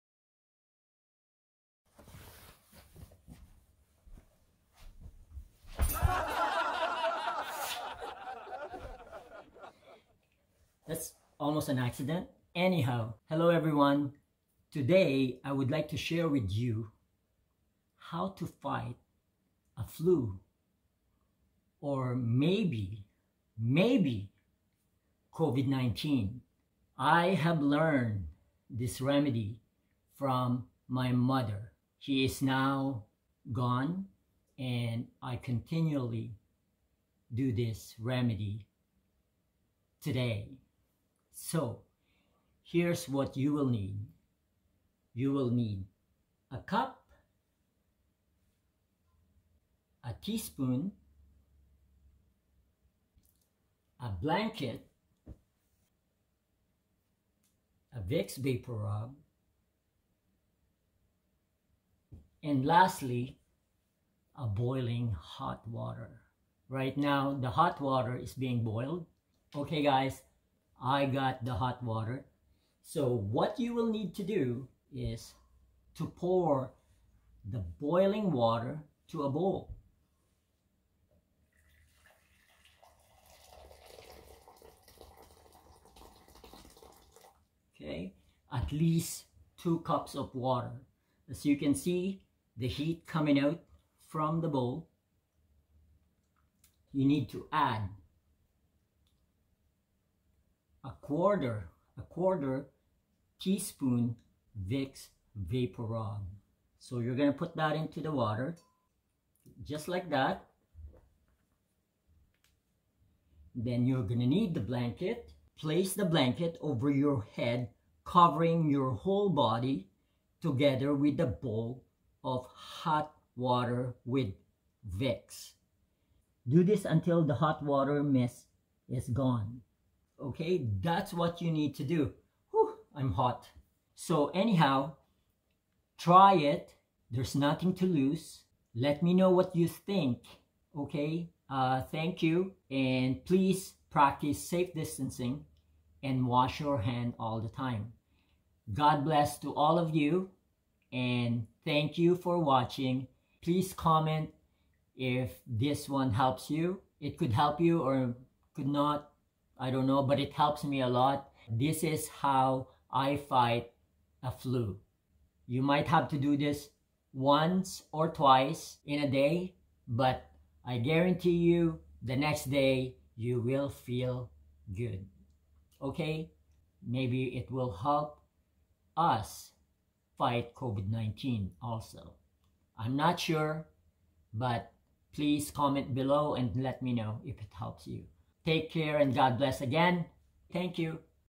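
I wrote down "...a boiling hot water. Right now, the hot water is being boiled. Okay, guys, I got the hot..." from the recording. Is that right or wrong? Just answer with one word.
right.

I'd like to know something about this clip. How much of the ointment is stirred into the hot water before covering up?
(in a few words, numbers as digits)
A quarter teaspoon.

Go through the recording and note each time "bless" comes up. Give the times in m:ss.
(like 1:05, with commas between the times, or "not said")
2:29, 3:09.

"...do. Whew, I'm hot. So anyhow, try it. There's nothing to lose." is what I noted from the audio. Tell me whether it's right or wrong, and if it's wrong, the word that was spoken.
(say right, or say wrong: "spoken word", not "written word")
right.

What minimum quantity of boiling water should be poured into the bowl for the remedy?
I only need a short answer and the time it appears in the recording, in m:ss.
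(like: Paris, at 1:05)
2 cups, at 1:29.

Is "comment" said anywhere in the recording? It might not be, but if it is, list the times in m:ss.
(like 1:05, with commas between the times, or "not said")
2:33, 3:05.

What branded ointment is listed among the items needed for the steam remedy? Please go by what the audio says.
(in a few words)
Vicks Vapor Rub.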